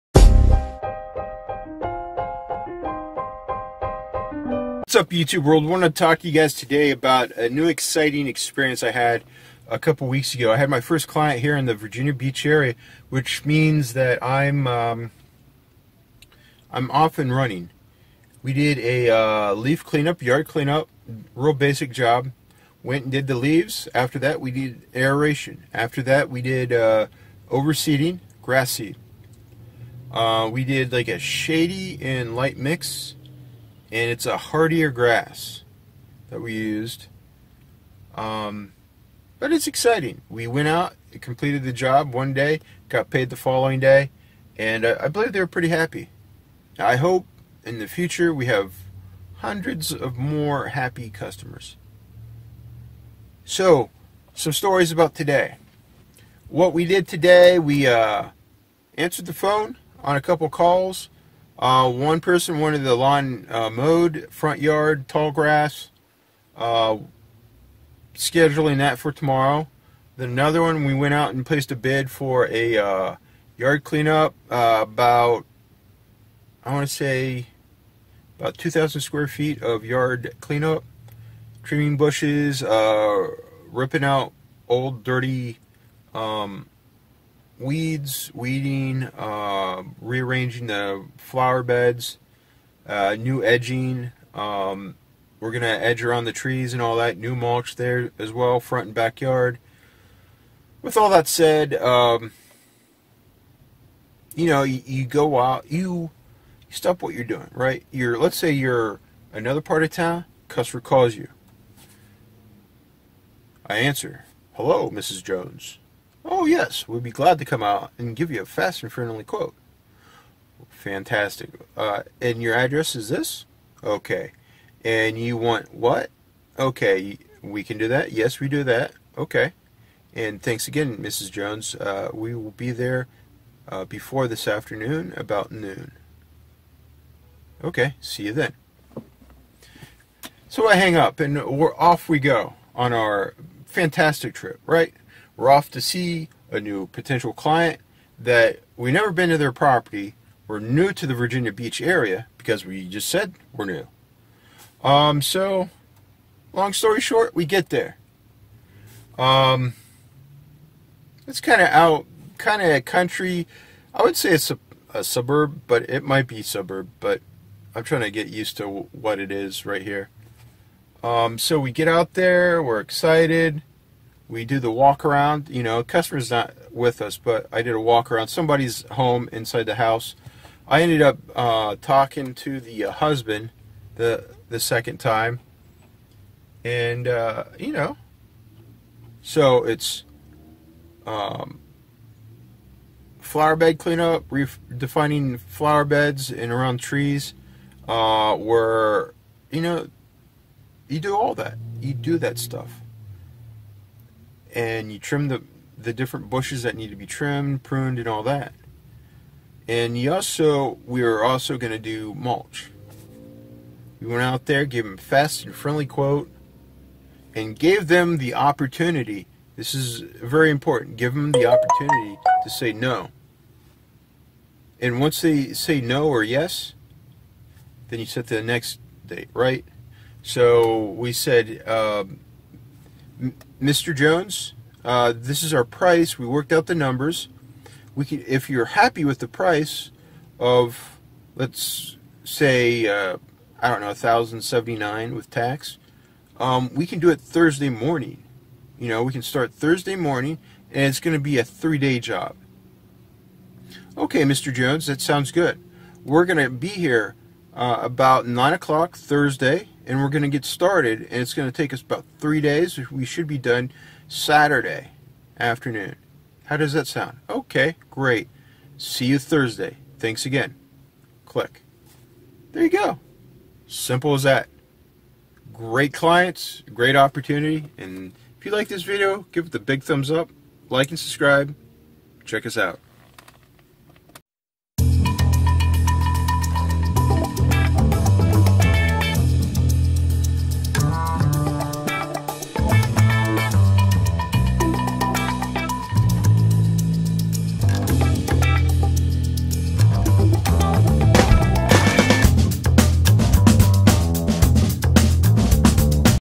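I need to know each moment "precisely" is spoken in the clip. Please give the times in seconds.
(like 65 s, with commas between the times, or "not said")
not said.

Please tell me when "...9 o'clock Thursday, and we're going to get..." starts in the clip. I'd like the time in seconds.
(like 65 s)
258 s.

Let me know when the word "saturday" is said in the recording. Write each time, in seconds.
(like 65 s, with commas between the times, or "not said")
264 s.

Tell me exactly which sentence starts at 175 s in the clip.
You know, customer's not with us, but I did a walk around somebody's home inside the house.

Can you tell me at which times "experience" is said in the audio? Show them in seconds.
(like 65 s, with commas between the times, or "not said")
8 s.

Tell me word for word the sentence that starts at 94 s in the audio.
Um, we're going to edge around the trees and all that, new mulch there as well, front and backyard.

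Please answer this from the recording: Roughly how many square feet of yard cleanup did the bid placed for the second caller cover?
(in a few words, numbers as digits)
2,000 square feet.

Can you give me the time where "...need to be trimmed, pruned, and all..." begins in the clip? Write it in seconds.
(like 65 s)
206 s.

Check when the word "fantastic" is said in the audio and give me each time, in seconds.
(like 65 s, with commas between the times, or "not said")
120 s, 143 s.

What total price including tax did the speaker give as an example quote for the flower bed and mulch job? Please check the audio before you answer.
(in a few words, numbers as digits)
1079.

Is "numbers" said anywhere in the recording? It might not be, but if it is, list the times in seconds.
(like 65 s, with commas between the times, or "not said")
236 s.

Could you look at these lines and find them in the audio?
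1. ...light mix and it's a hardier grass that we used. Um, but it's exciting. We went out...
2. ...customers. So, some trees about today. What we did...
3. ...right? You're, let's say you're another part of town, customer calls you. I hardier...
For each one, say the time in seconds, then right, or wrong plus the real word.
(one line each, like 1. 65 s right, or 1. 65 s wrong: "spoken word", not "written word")
1. 32 s right
2. 51 s wrong: "stories", not "trees"
3. 107 s wrong: "answer", not "hardier".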